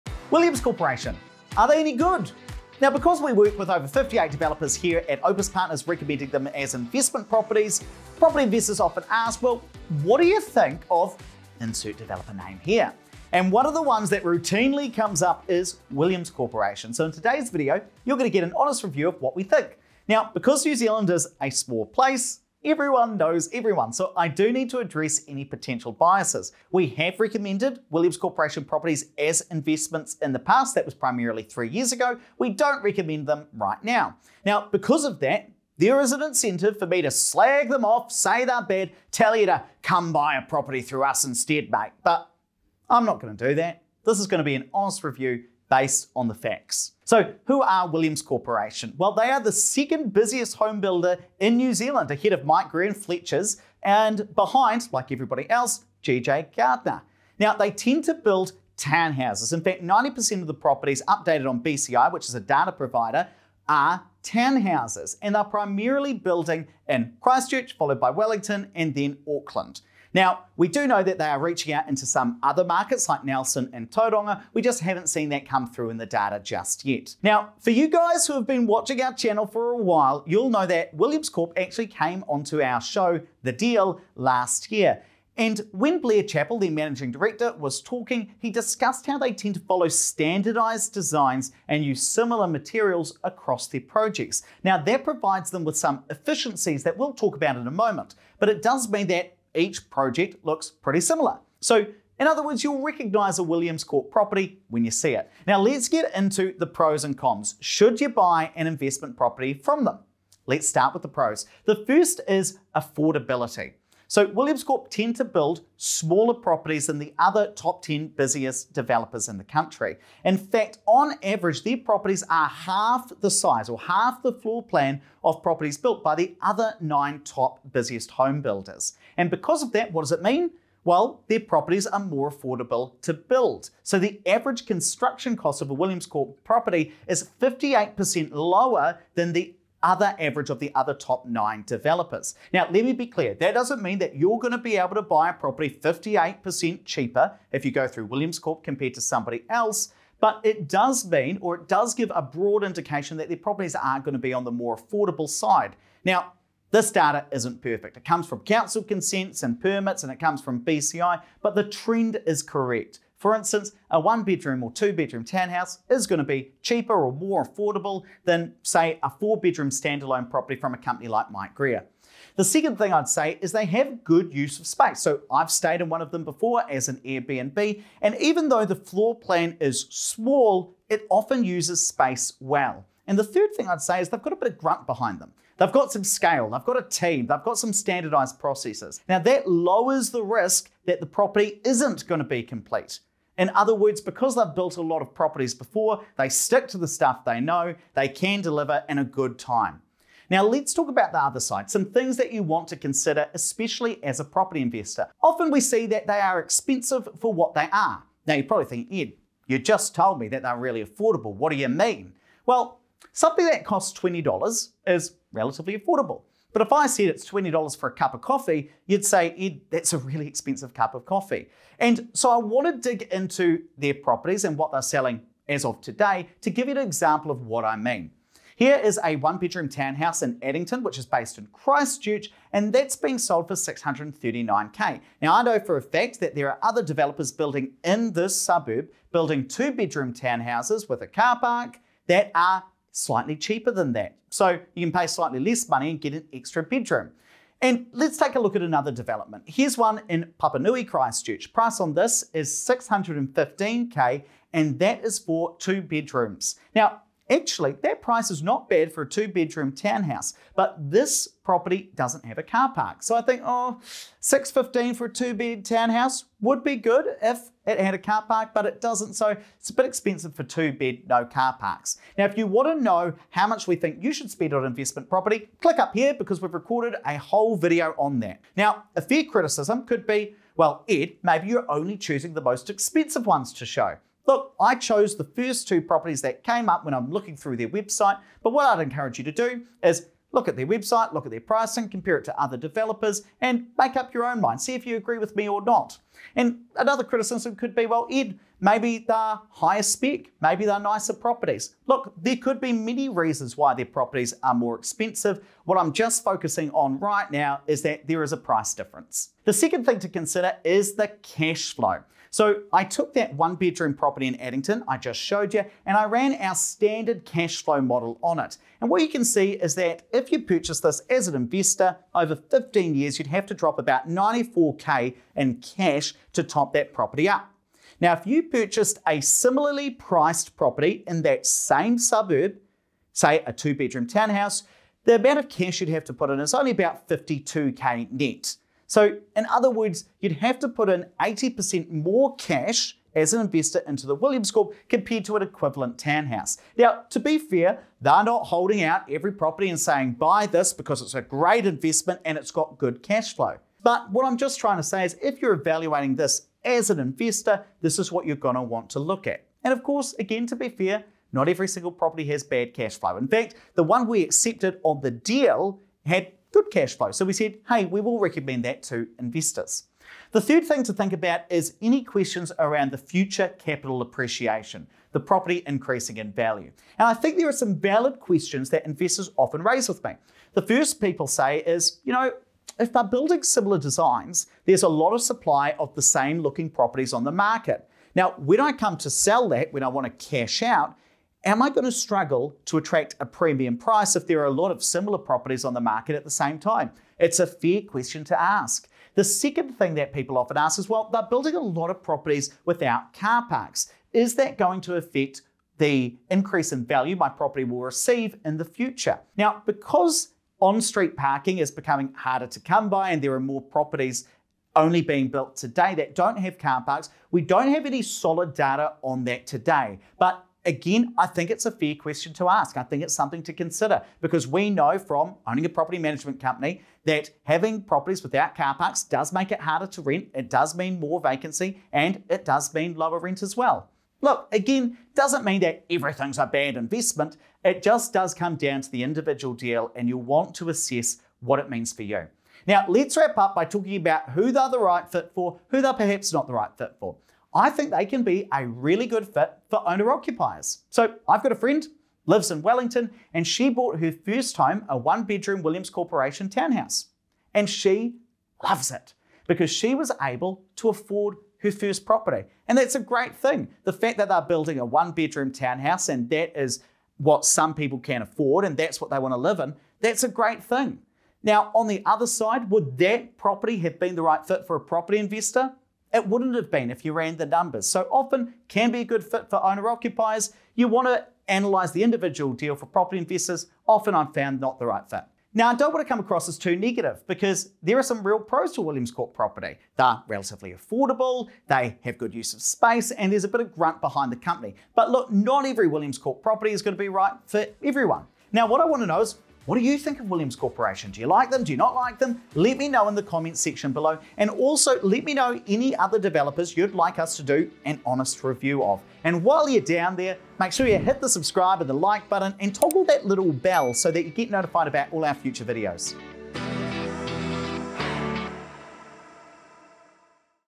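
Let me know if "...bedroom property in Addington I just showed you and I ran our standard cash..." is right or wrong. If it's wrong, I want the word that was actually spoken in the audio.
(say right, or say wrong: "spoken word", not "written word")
right.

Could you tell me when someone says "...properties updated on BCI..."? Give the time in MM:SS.
01:00.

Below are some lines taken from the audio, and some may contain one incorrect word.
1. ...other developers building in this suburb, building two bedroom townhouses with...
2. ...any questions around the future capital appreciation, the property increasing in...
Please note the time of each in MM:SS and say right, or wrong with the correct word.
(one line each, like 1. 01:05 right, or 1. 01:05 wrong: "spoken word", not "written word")
1. 03:56 right
2. 06:11 right.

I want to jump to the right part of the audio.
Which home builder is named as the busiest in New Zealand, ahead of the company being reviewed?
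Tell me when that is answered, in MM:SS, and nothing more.
00:56.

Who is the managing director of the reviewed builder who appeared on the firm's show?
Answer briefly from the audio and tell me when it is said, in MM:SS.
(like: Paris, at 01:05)
Blair Chappell, at 01:26.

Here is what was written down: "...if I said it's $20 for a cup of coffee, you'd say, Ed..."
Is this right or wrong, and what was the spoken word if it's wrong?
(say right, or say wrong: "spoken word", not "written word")
right.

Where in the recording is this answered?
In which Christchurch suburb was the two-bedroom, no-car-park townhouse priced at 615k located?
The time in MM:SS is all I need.
04:10.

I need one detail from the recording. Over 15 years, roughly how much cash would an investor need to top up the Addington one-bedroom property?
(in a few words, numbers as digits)
$94k.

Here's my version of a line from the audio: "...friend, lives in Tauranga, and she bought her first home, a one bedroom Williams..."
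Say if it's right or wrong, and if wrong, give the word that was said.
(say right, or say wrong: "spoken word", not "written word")
wrong: "Wellington", not "Tauranga".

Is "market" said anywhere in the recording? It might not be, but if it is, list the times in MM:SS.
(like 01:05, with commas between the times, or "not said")
01:12, 06:27, 06:35.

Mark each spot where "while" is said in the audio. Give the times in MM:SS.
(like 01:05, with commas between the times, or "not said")
01:19, 08:29.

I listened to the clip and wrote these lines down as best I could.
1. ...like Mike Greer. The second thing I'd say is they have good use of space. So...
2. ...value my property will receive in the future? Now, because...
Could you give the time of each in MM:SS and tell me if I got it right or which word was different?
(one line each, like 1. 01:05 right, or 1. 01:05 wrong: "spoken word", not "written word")
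1. 02:51 right
2. 06:46 right.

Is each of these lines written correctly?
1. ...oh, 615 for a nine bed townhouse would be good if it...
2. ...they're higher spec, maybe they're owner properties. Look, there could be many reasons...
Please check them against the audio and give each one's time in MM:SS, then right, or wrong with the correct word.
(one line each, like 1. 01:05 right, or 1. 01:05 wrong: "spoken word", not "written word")
1. 04:23 wrong: "two", not "nine"
2. 04:58 wrong: "nicer", not "owner".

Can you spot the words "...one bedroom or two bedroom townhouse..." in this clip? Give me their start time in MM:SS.
02:43.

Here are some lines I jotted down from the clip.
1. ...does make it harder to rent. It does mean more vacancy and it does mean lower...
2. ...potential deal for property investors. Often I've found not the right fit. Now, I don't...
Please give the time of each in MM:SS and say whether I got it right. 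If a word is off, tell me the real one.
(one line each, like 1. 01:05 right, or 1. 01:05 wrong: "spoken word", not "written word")
1. 07:09 right
2. 08:02 wrong: "individual", not "potential".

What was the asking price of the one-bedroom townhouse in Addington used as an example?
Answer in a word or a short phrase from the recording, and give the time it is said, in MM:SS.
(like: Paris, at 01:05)
$639k, at 03:53.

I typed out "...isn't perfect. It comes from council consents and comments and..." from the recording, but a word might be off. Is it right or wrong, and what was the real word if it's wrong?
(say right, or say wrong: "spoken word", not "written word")
wrong: "permits", not "comments".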